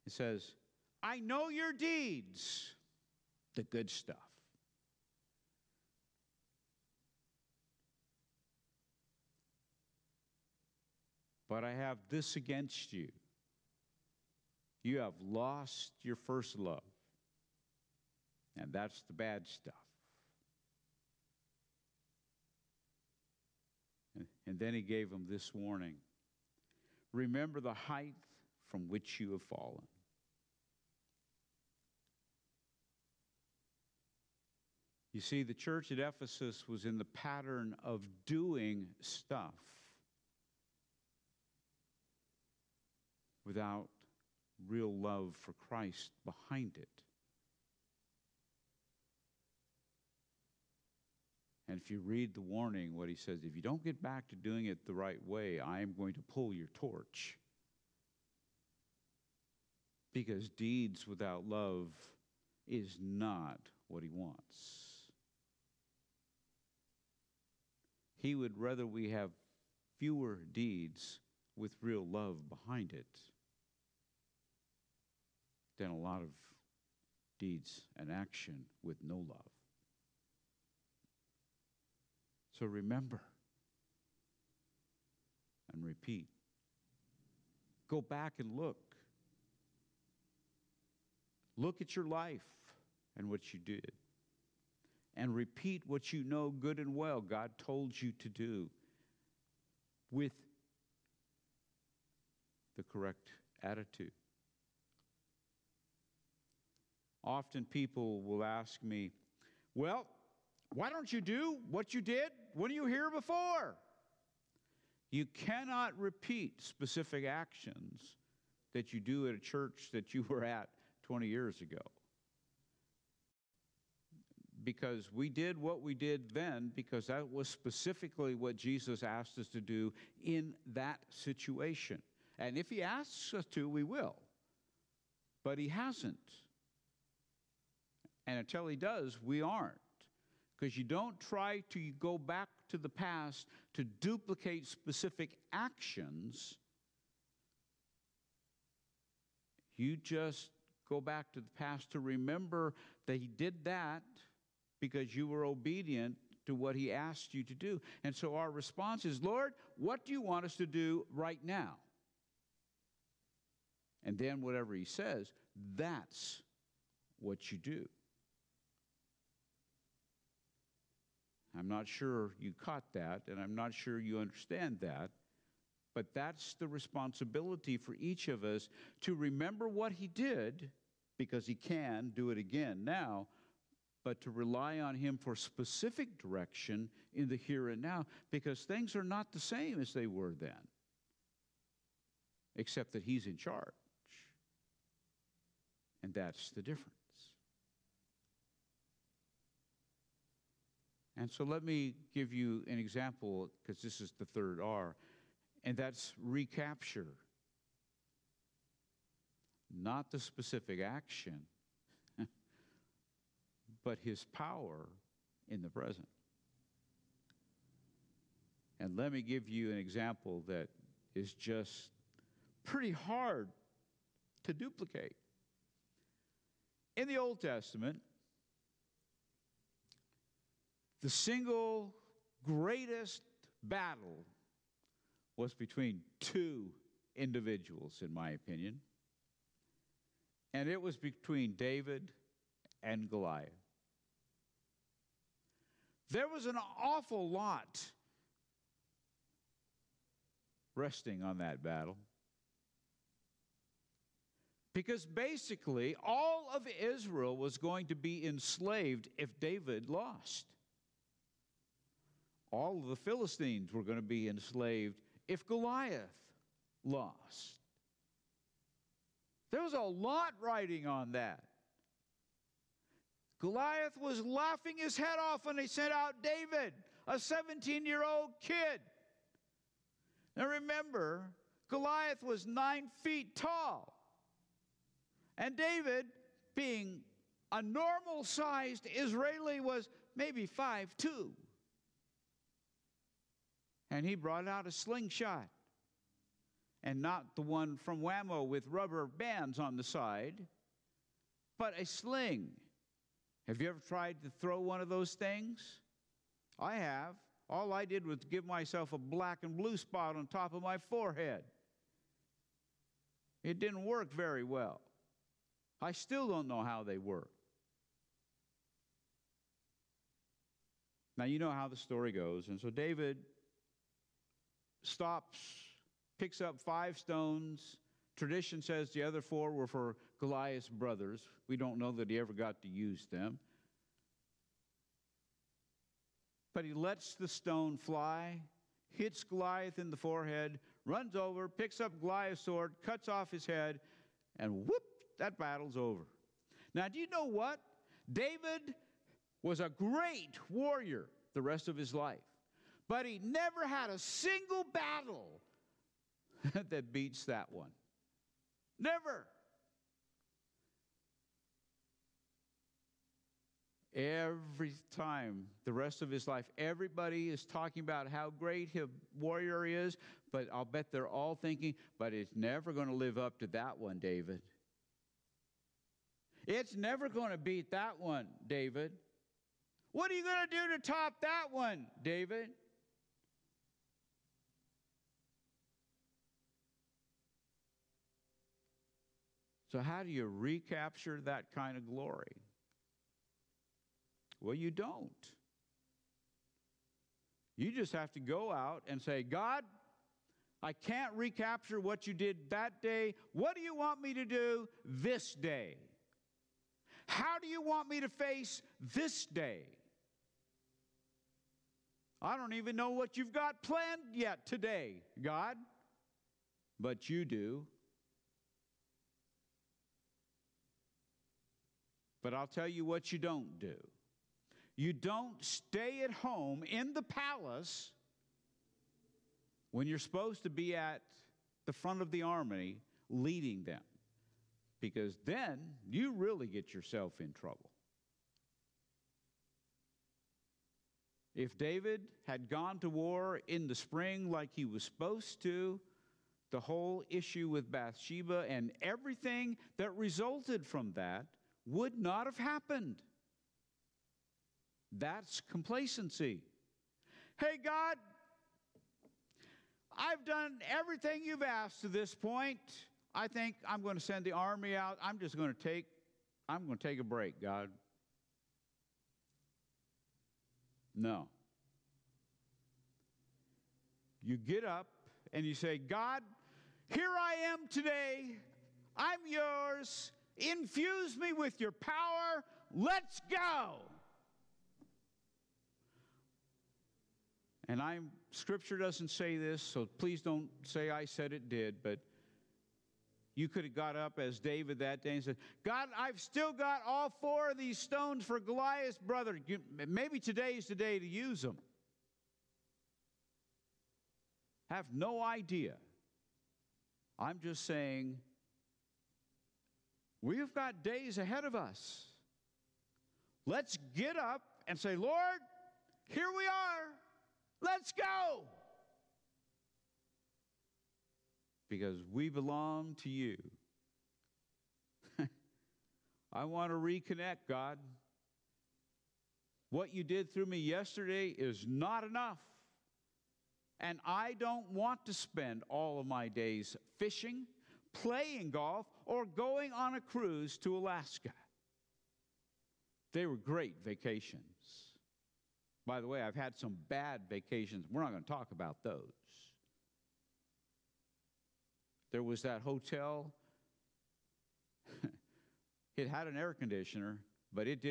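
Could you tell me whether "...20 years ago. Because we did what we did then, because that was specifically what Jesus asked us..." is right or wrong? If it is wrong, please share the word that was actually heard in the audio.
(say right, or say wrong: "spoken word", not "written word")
right.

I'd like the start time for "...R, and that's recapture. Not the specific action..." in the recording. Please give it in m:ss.
3:24.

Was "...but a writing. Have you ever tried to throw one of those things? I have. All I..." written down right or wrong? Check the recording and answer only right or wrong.
wrong.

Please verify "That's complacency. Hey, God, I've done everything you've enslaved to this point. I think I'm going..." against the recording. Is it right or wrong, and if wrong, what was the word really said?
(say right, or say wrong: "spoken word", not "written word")
wrong: "asked", not "enslaved".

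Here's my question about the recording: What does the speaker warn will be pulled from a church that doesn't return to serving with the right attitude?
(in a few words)
torch.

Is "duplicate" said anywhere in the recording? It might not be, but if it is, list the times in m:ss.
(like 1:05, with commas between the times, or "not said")
2:23, 3:44.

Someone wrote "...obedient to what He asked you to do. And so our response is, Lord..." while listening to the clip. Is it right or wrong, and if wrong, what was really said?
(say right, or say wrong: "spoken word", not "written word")
right.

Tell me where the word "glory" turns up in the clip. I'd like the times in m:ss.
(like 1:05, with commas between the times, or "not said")
6:31.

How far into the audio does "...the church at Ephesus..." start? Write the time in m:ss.
0:35.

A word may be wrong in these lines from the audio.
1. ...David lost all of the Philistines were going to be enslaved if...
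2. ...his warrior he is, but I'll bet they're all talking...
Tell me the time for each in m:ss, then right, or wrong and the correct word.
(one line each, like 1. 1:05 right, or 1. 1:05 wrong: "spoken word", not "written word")
1. 4:19 right
2. 6:08 wrong: "thinking", not "talking".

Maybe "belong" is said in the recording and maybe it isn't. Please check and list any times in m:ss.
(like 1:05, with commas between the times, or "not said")
8:42.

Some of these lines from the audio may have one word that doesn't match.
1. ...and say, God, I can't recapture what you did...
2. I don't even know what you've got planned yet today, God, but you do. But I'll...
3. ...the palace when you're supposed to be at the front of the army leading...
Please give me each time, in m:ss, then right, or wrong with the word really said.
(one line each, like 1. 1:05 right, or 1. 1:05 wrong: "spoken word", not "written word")
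1. 6:38 right
2. 6:52 right
3. 7:06 right.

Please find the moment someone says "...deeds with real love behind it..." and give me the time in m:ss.
1:10.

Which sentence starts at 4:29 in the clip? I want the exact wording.
There was a lot writing on that.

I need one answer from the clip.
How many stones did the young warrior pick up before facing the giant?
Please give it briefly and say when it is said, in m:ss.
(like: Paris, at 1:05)
5, at 5:26.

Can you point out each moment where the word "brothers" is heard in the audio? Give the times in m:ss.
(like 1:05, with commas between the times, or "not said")
5:30, 8:18.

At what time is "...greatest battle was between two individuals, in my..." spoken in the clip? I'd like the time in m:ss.
3:52.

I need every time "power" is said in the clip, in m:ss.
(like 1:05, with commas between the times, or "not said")
3:34, 8:01.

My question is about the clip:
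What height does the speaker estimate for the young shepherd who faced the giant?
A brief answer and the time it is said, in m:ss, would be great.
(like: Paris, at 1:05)
5'2", at 4:50.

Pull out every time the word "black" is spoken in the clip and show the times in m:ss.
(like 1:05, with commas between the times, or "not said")
5:08.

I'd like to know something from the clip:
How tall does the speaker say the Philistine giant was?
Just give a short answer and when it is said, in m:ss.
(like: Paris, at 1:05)
9 feet, at 4:42.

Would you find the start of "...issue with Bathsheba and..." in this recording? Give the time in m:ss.
7:27.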